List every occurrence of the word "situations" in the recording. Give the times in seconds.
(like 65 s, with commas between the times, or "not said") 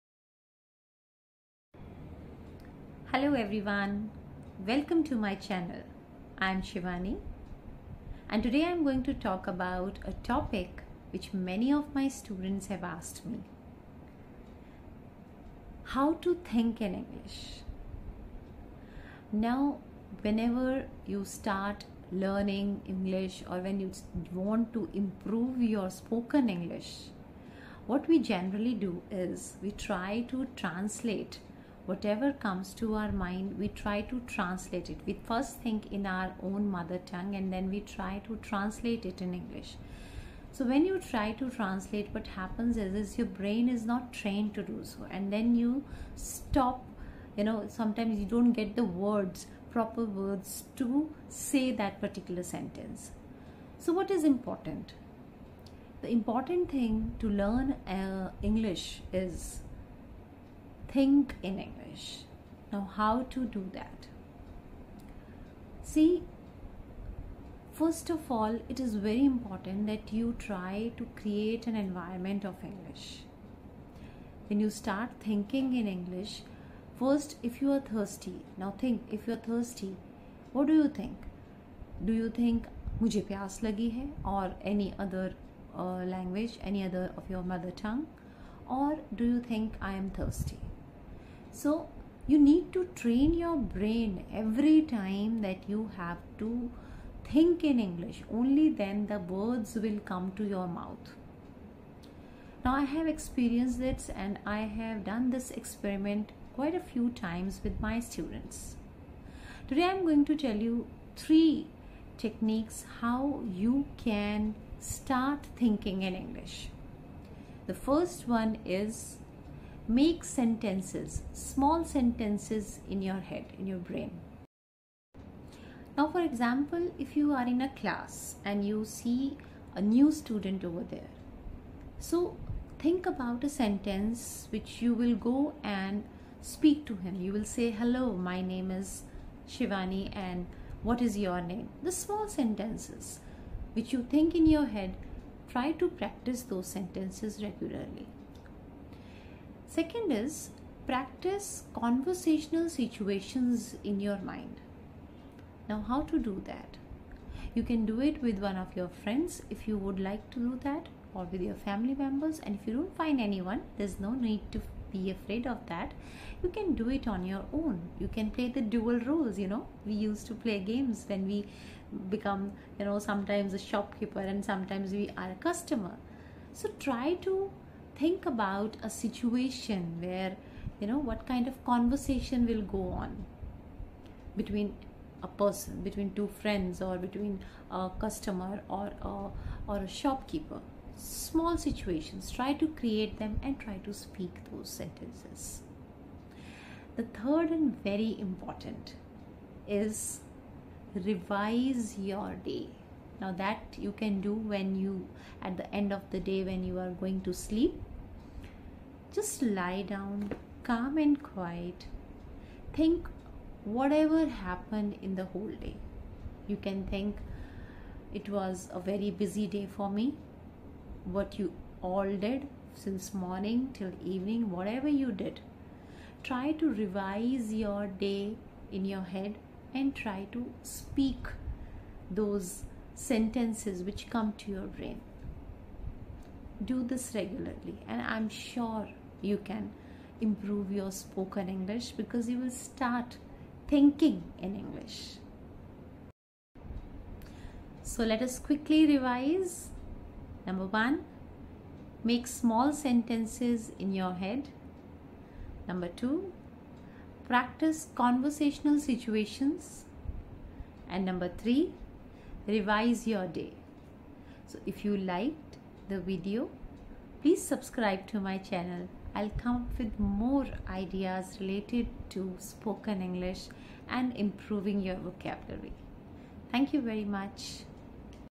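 152 s, 178 s, 191 s, 258 s.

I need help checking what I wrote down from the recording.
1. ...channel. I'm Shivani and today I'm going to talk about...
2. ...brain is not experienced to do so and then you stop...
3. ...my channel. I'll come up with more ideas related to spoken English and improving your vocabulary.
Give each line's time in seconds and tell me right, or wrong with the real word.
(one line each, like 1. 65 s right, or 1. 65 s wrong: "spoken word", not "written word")
1. 5 s right
2. 43 s wrong: "trained", not "experienced"
3. 268 s right.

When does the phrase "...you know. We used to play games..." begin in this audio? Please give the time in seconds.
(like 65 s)
169 s.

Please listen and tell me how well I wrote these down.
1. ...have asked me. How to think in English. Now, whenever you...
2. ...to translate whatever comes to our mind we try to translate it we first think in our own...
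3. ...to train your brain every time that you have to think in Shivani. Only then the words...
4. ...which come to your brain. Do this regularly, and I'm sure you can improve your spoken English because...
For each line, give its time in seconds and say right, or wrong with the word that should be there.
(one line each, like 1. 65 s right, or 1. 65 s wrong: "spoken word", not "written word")
1. 12 s right
2. 30 s right
3. 92 s wrong: "English", not "Shivani"
4. 233 s right.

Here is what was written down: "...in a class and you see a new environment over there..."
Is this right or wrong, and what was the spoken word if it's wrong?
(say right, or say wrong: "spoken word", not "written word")
wrong: "student", not "environment".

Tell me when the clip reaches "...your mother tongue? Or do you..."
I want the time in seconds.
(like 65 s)
87 s.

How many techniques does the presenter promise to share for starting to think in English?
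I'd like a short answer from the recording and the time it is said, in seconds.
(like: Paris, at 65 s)
3, at 111 s.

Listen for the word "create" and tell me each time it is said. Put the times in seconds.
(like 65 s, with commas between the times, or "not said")
71 s, 192 s.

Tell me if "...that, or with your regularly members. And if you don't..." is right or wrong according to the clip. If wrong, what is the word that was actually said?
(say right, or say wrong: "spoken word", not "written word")
wrong: "family", not "regularly".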